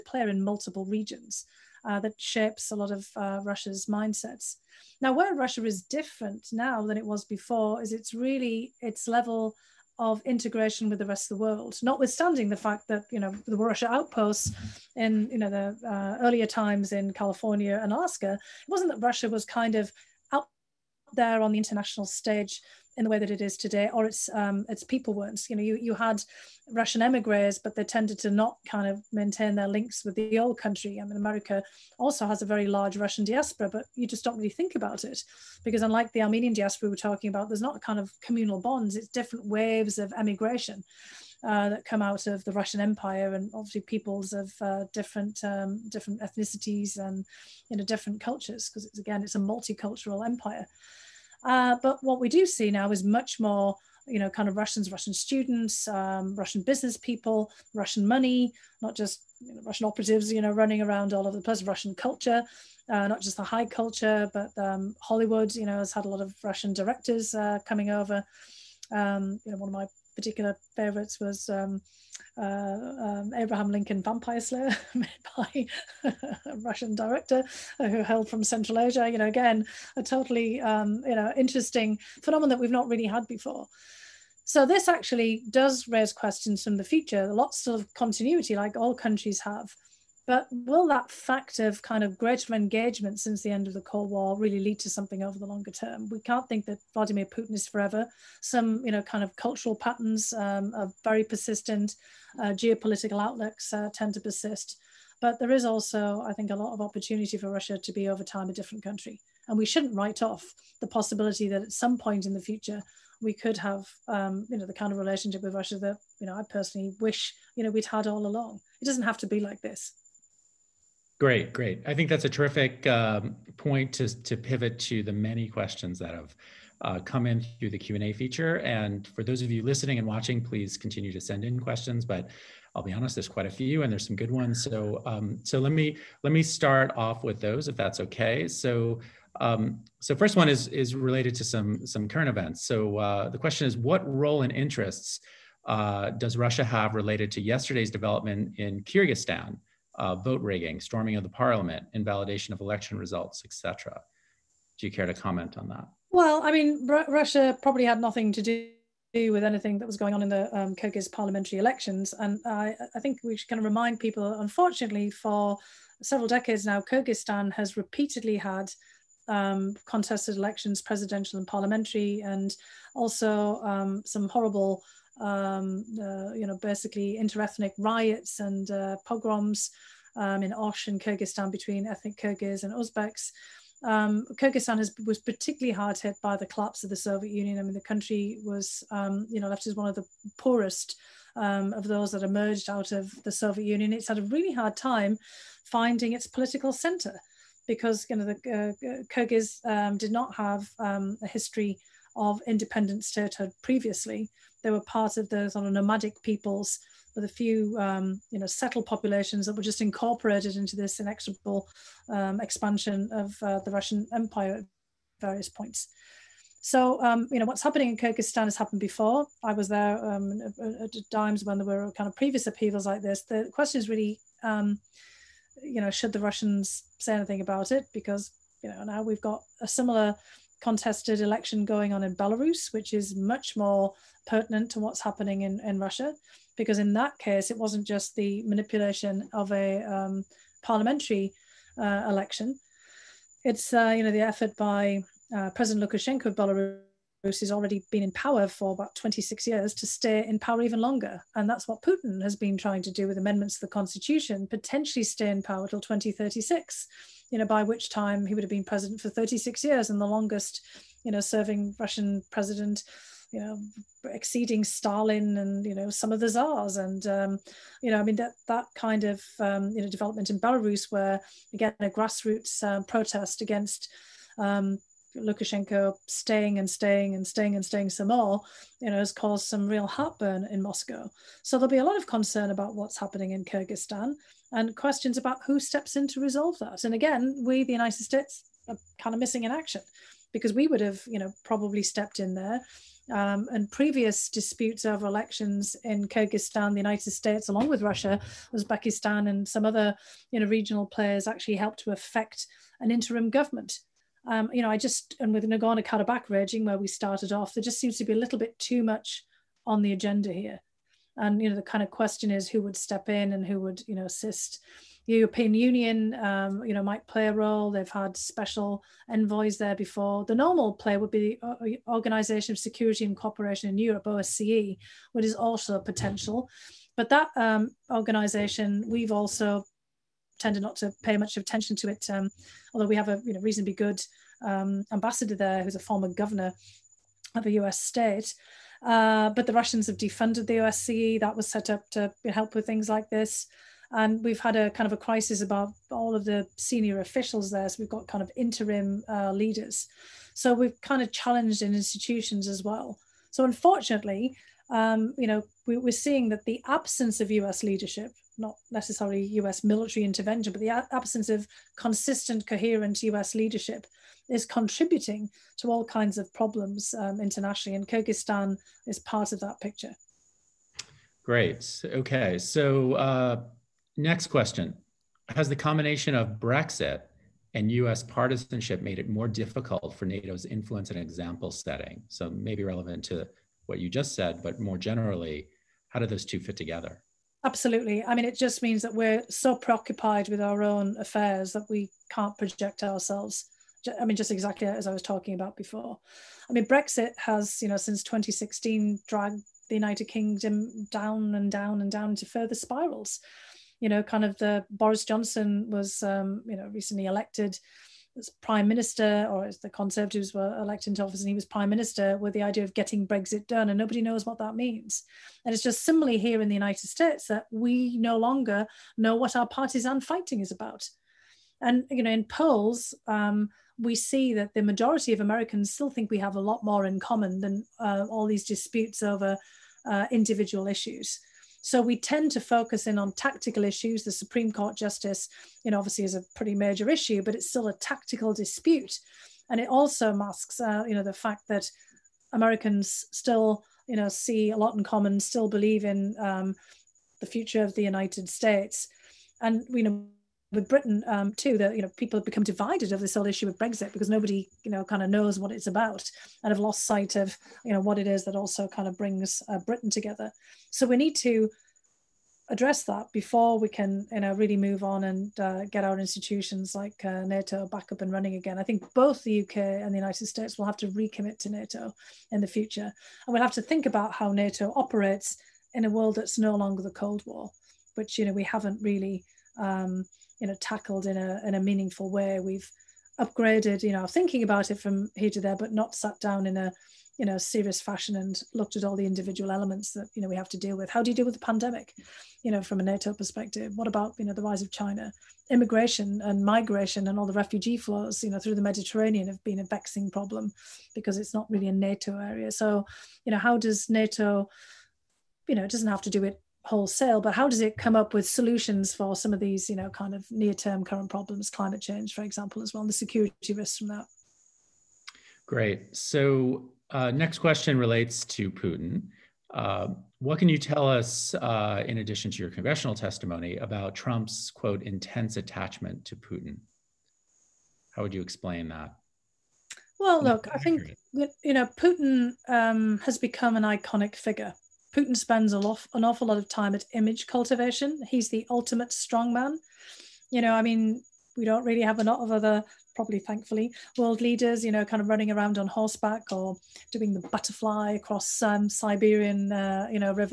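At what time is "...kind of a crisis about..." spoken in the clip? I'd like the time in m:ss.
5:44.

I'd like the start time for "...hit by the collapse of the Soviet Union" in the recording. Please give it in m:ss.
3:05.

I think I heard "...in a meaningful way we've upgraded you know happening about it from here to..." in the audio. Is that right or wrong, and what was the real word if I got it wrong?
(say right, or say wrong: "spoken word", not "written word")
wrong: "thinking", not "happening".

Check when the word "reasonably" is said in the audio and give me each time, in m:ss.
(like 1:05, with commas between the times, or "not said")
5:33.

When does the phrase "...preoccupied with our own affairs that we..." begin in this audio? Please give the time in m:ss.
6:29.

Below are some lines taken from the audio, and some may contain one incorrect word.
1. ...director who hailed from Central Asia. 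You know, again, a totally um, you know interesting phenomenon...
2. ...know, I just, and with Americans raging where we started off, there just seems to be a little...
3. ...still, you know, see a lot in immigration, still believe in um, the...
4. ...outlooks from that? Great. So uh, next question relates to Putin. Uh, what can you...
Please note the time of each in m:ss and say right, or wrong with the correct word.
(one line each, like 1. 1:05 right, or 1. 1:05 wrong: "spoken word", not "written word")
1. 1:16 right
2. 5:04 wrong: "Karabakh", not "Americans"
3. 7:23 wrong: "common", not "immigration"
4. 8:33 wrong: "risks", not "outlooks".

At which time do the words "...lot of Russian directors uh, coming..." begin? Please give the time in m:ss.
1:06.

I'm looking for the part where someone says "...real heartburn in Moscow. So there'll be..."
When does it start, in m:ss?
4:39.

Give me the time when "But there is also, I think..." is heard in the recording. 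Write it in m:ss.
1:45.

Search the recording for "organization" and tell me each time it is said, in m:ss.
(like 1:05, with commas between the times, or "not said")
5:21, 5:27.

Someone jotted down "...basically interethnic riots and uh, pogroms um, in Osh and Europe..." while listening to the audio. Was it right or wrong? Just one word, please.
wrong.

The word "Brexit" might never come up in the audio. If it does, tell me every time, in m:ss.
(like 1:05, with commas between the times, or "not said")
6:16, 6:36, 6:53, 7:33.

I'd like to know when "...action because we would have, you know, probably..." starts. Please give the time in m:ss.
4:49.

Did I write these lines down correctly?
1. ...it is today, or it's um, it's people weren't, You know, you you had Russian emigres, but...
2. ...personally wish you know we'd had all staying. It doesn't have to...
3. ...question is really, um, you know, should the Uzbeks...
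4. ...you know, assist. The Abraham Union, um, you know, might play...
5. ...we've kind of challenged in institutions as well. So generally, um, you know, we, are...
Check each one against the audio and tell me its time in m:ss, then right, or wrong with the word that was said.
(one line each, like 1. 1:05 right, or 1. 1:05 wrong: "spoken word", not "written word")
1. 0:23 right
2. 1:56 wrong: "along", not "staying"
3. 3:43 wrong: "Russians", not "Uzbeks"
4. 5:13 wrong: "European", not "Abraham"
5. 5:50 wrong: "unfortunately", not "generally".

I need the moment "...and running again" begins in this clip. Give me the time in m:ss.
7:48.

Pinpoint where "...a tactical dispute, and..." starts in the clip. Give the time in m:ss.
7:17.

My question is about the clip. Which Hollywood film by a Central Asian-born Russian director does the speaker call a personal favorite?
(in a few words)
Abraham Lincoln Vampire Slayer.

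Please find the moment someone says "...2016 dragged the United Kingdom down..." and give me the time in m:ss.
6:38.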